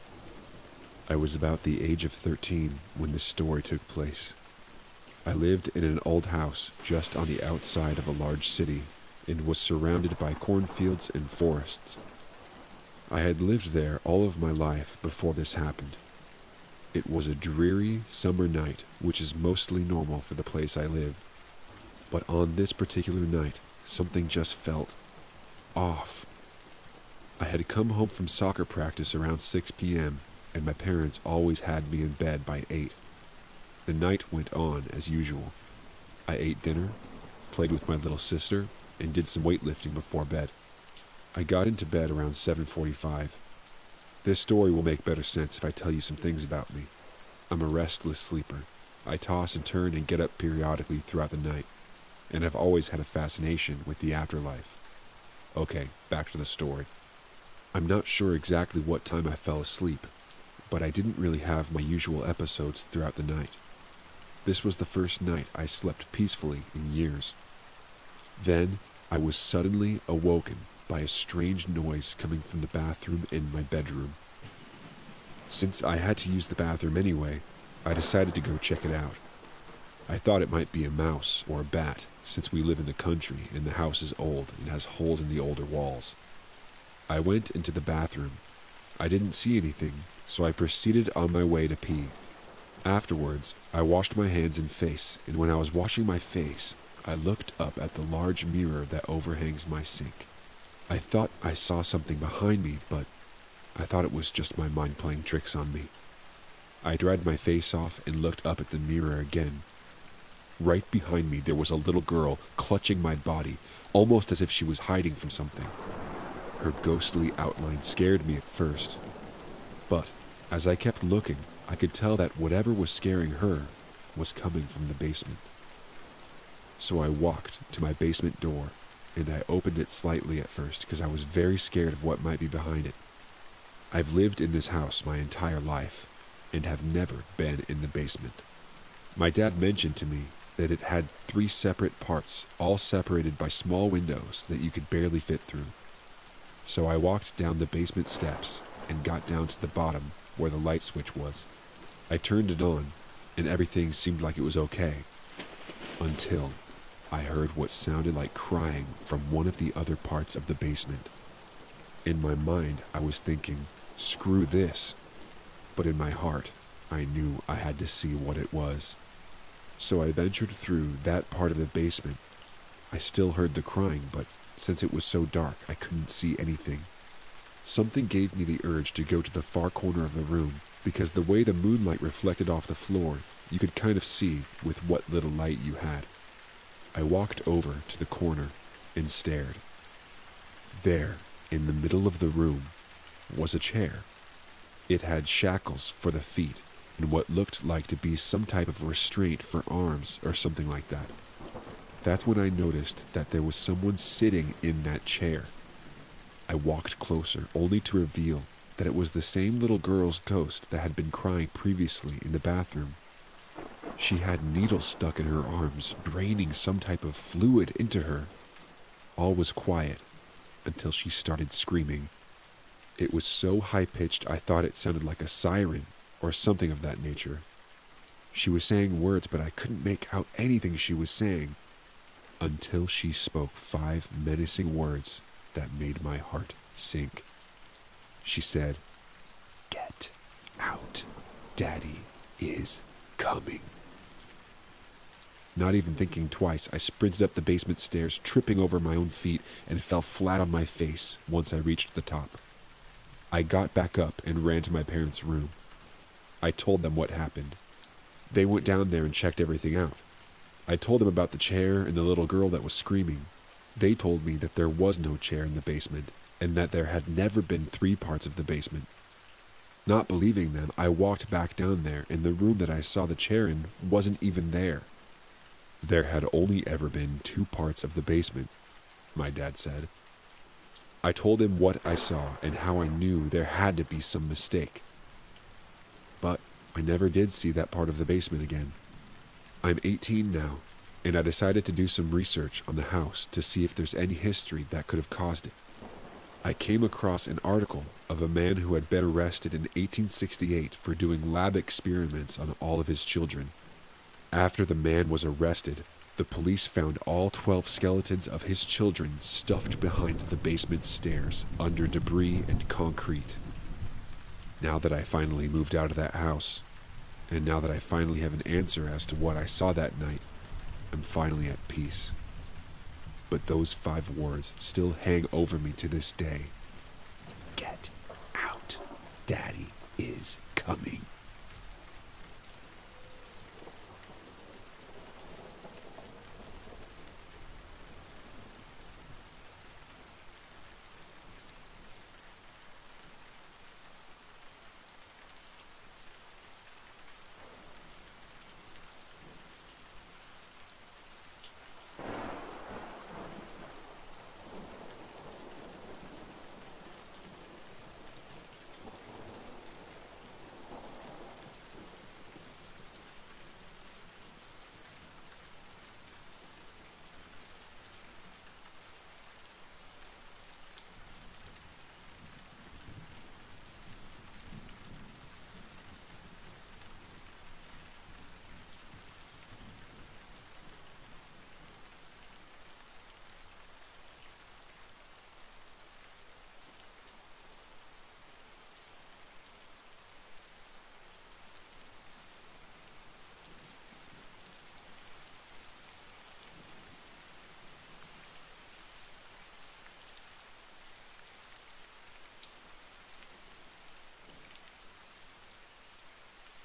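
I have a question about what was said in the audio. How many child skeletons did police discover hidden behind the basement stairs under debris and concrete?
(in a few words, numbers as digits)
12.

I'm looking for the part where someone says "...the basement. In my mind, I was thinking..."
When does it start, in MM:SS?
02:40.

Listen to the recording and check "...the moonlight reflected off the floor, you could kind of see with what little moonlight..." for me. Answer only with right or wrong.
wrong.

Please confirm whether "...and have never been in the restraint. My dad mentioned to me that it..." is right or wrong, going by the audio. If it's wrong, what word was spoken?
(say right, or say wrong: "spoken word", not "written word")
wrong: "basement", not "restraint".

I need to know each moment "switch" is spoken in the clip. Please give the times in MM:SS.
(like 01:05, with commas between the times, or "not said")
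02:30.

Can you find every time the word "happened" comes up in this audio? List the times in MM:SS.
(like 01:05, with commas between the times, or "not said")
00:15, 04:17.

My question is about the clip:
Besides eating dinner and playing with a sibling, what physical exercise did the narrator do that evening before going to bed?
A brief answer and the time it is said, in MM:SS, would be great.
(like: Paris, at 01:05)
weightlifting, at 00:39.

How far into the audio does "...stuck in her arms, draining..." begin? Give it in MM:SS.
03:34.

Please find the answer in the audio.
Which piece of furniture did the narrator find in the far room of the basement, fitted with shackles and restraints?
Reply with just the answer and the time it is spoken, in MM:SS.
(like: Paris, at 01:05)
a chair, at 03:13.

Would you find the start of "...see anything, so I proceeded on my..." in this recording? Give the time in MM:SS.
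01:29.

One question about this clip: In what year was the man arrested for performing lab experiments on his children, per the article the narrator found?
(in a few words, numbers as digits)
1868.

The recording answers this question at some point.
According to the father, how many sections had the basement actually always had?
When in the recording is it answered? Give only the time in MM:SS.
04:37.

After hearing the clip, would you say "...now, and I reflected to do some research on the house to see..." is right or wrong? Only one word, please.
wrong.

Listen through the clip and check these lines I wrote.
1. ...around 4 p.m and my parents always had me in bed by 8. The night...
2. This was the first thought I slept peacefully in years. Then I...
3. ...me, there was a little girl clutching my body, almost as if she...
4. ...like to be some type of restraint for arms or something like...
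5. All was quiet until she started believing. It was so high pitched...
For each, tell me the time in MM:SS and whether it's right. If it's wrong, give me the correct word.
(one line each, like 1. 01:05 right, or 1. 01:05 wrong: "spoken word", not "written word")
1. 00:29 wrong: "6", not "4"
2. 01:04 wrong: "night", not "thought"
3. 01:51 right
4. 03:17 right
5. 03:39 wrong: "screaming", not "believing".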